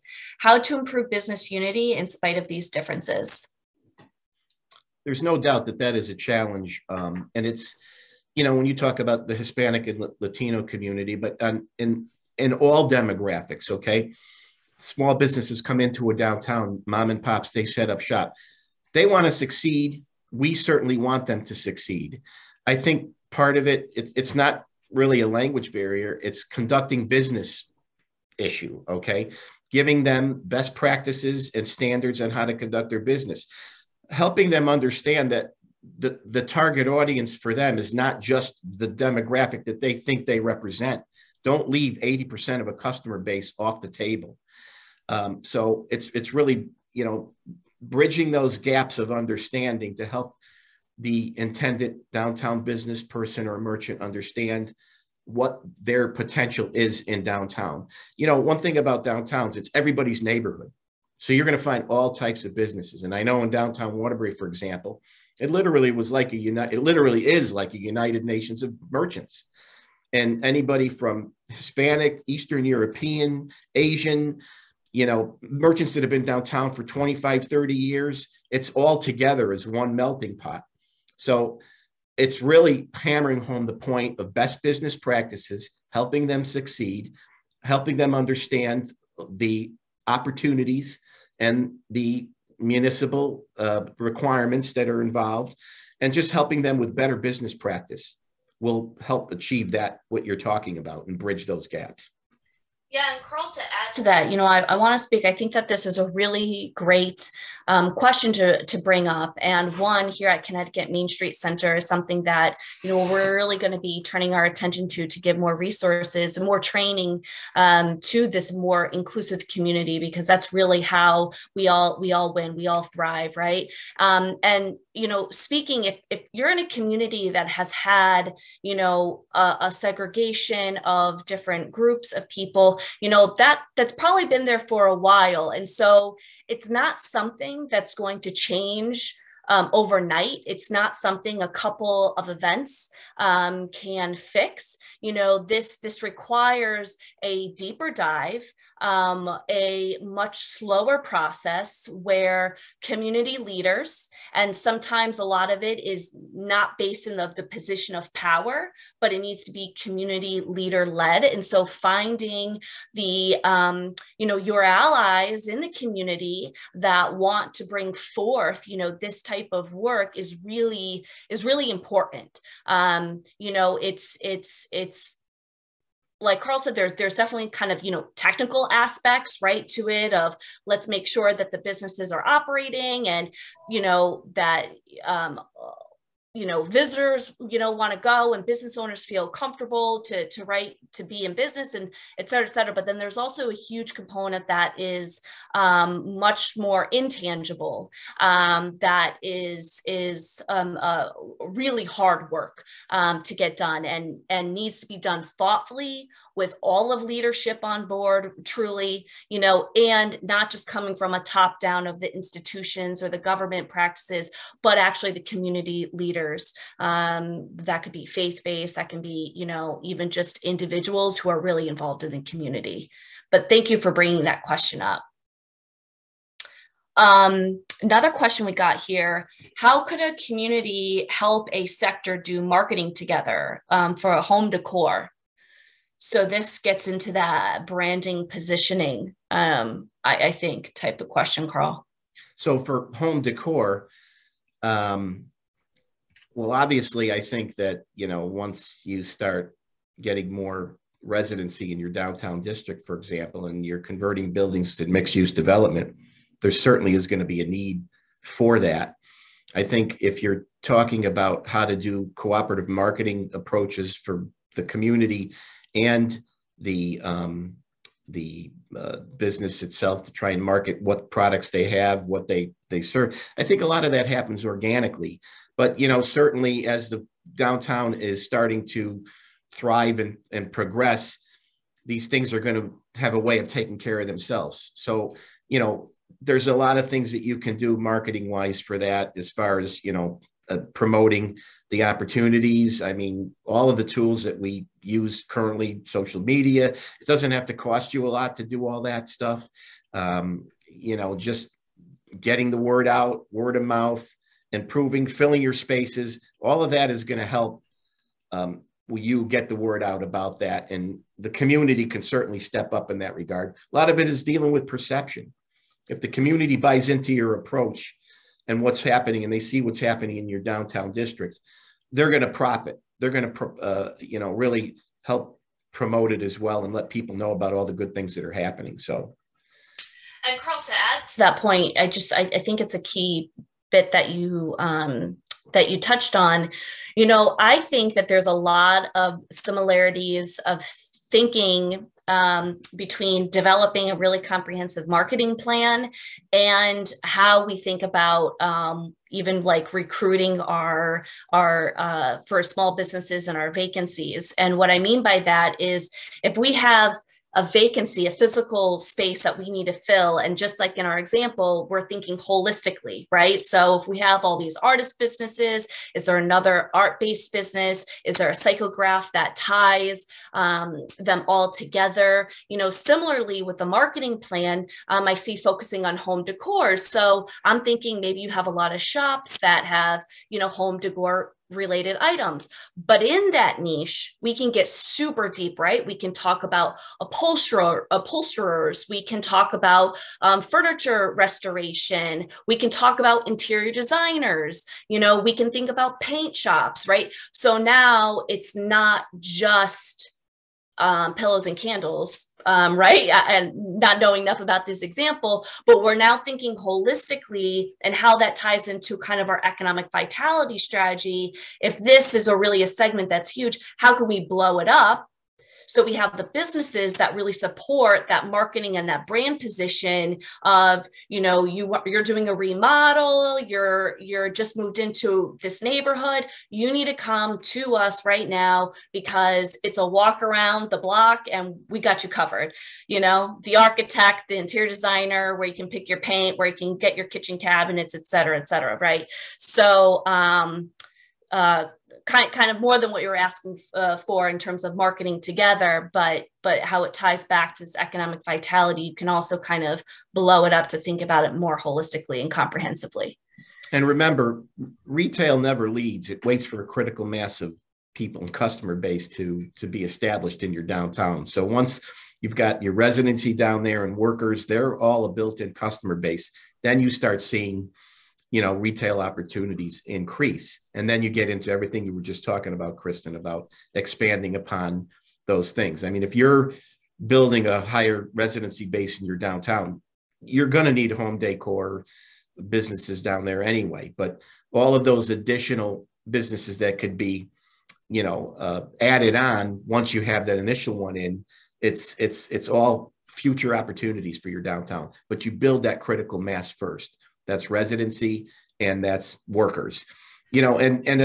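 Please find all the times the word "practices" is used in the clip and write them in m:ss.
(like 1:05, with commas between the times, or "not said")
0:30, 1:24, 1:37, 3:33.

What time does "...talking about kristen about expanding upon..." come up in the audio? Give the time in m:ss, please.
7:52.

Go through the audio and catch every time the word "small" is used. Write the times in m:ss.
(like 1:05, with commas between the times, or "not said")
0:14, 5:52.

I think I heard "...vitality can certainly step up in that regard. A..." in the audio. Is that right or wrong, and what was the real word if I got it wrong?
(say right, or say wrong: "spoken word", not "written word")
wrong: "community", not "vitality".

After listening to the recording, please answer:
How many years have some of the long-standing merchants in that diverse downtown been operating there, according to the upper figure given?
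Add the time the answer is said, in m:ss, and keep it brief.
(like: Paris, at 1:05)
30 years, at 1:17.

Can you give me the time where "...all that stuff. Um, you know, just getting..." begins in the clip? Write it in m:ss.
4:58.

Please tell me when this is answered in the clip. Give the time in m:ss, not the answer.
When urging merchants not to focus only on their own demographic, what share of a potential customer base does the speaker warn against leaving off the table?
0:42.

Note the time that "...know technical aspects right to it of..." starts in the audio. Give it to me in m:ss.
2:57.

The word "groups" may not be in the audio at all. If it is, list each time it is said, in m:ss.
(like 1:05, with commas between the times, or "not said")
2:11.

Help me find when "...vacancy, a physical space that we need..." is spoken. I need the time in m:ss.
5:57.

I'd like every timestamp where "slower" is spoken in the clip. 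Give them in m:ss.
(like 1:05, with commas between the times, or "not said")
2:30.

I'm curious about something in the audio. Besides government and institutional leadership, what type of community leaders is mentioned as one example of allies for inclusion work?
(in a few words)
Faith based.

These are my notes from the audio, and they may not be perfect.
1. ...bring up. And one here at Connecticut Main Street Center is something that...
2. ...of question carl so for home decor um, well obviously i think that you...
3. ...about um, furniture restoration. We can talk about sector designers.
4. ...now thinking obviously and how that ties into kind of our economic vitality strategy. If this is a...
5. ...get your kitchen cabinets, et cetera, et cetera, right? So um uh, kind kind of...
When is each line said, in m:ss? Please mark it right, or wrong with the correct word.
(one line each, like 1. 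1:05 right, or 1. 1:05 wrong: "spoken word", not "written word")
1. 1:48 right
2. 4:01 right
3. 6:29 wrong: "interior", not "sector"
4. 6:45 wrong: "holistically", not "obviously"
5. 7:16 right.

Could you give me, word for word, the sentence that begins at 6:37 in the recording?
So now it's not just um, pillows and candles, um, right?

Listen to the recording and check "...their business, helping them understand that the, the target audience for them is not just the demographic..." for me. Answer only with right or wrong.
right.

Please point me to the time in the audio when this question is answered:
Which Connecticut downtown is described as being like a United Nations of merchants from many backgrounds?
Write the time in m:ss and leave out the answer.
1:03.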